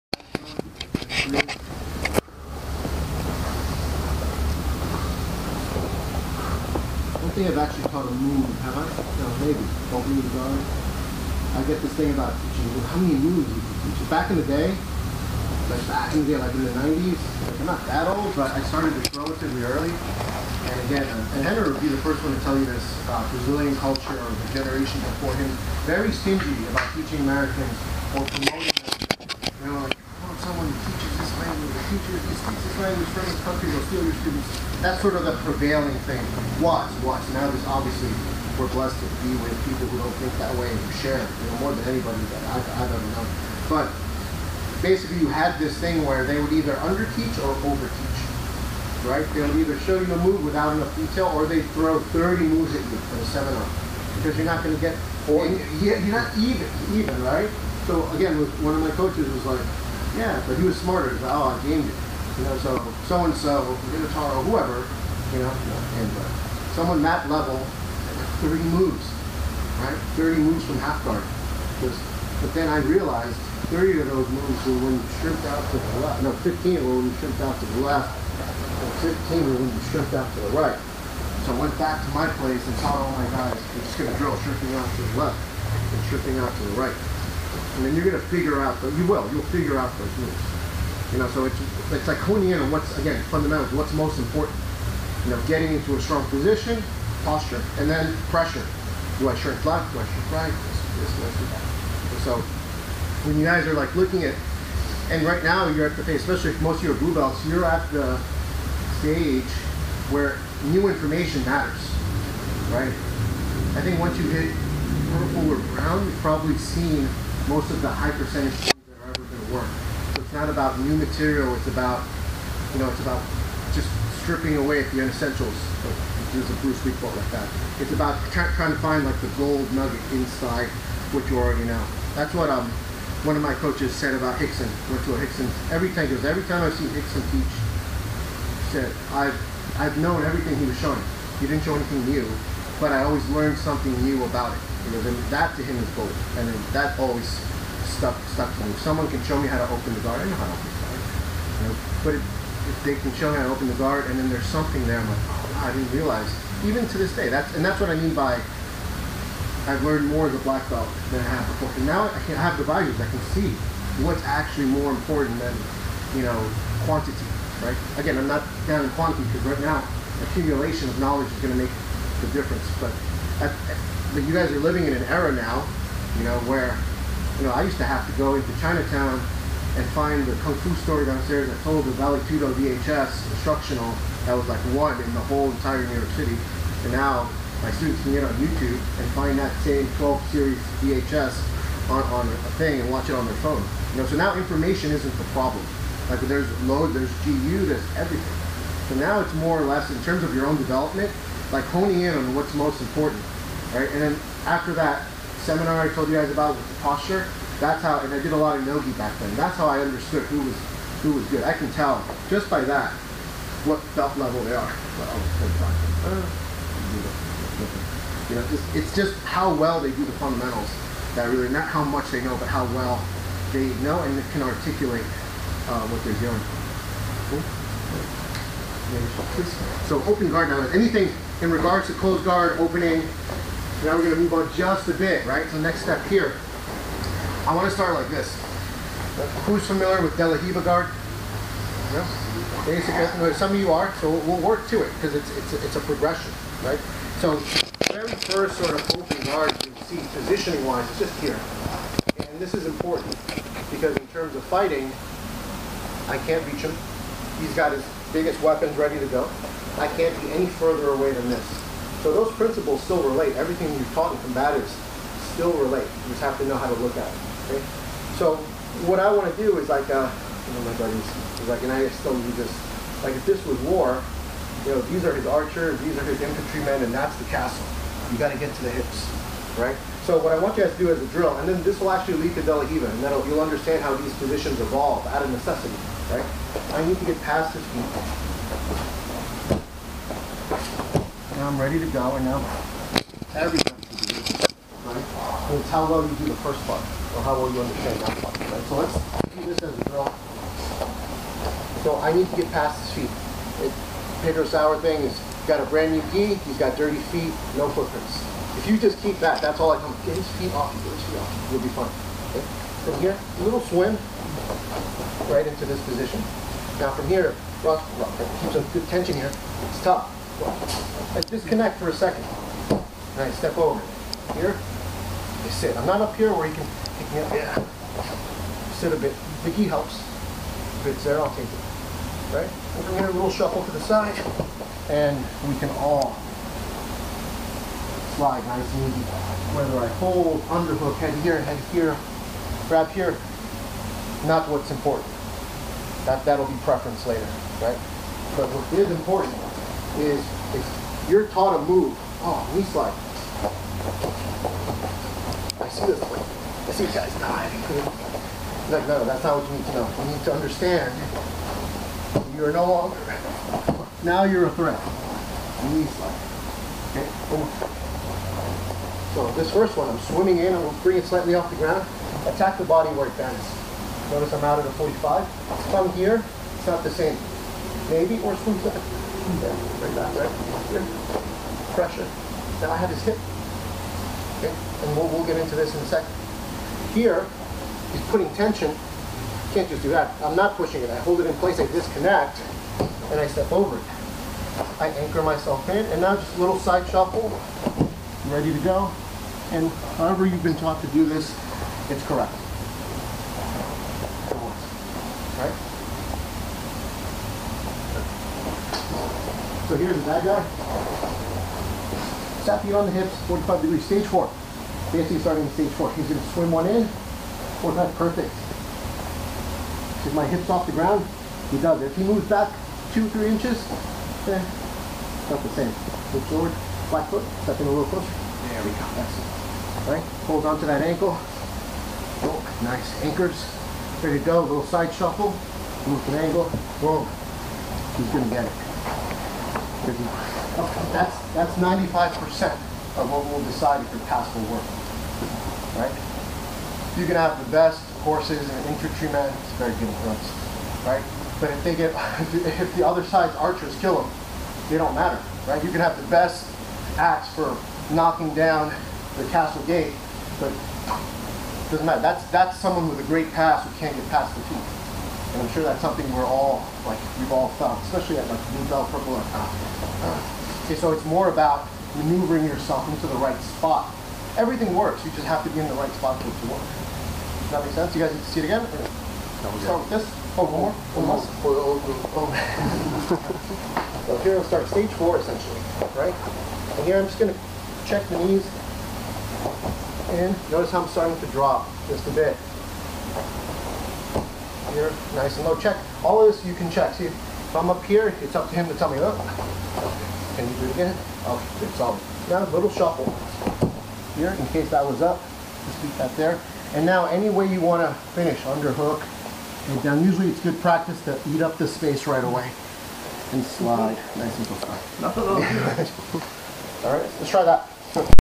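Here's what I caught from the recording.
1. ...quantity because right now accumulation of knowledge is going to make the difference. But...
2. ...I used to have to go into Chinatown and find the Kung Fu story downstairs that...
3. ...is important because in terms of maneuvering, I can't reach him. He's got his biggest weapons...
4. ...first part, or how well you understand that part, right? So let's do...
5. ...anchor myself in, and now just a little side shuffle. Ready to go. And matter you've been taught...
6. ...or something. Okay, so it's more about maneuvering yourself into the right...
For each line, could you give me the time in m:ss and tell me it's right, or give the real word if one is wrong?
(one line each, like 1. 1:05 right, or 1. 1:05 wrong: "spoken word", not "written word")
1. 2:48 right
2. 2:57 right
3. 4:12 wrong: "fighting", not "maneuvering"
4. 4:56 right
5. 6:34 wrong: "however", not "matter"
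6. 7:49 right.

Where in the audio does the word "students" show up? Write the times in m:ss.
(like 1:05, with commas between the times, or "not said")
0:34, 3:07.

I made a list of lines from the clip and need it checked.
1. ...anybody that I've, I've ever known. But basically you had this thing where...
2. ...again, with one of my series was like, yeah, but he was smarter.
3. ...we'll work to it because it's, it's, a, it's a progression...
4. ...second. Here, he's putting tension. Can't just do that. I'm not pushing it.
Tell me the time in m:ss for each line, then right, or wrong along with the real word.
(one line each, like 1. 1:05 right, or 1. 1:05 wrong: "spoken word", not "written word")
1. 0:41 right
2. 0:58 wrong: "coaches", not "series"
3. 4:04 right
4. 6:25 right.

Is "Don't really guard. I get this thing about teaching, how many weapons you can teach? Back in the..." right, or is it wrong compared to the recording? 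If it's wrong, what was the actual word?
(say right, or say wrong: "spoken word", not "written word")
wrong: "moons", not "weapons".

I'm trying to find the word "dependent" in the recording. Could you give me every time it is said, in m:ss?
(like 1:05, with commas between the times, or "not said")
not said.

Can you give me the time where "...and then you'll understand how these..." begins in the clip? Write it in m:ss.
4:42.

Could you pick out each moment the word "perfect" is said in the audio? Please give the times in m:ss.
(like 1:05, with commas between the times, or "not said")
6:57.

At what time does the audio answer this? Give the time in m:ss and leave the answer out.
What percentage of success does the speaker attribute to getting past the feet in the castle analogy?
7:21.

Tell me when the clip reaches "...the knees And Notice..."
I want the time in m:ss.
8:08.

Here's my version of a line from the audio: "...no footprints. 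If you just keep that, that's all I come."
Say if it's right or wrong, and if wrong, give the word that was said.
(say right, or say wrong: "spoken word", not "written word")
right.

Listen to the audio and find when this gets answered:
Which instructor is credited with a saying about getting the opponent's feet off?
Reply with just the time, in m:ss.
5:04.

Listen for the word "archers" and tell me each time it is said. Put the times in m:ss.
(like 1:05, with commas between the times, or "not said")
4:35, 7:33.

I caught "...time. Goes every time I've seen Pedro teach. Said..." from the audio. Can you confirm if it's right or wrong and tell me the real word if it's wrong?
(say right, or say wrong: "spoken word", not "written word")
wrong: "Rickson", not "Pedro".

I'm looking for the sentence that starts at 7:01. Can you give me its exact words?
If he moves back two, three inches, eh, not the same.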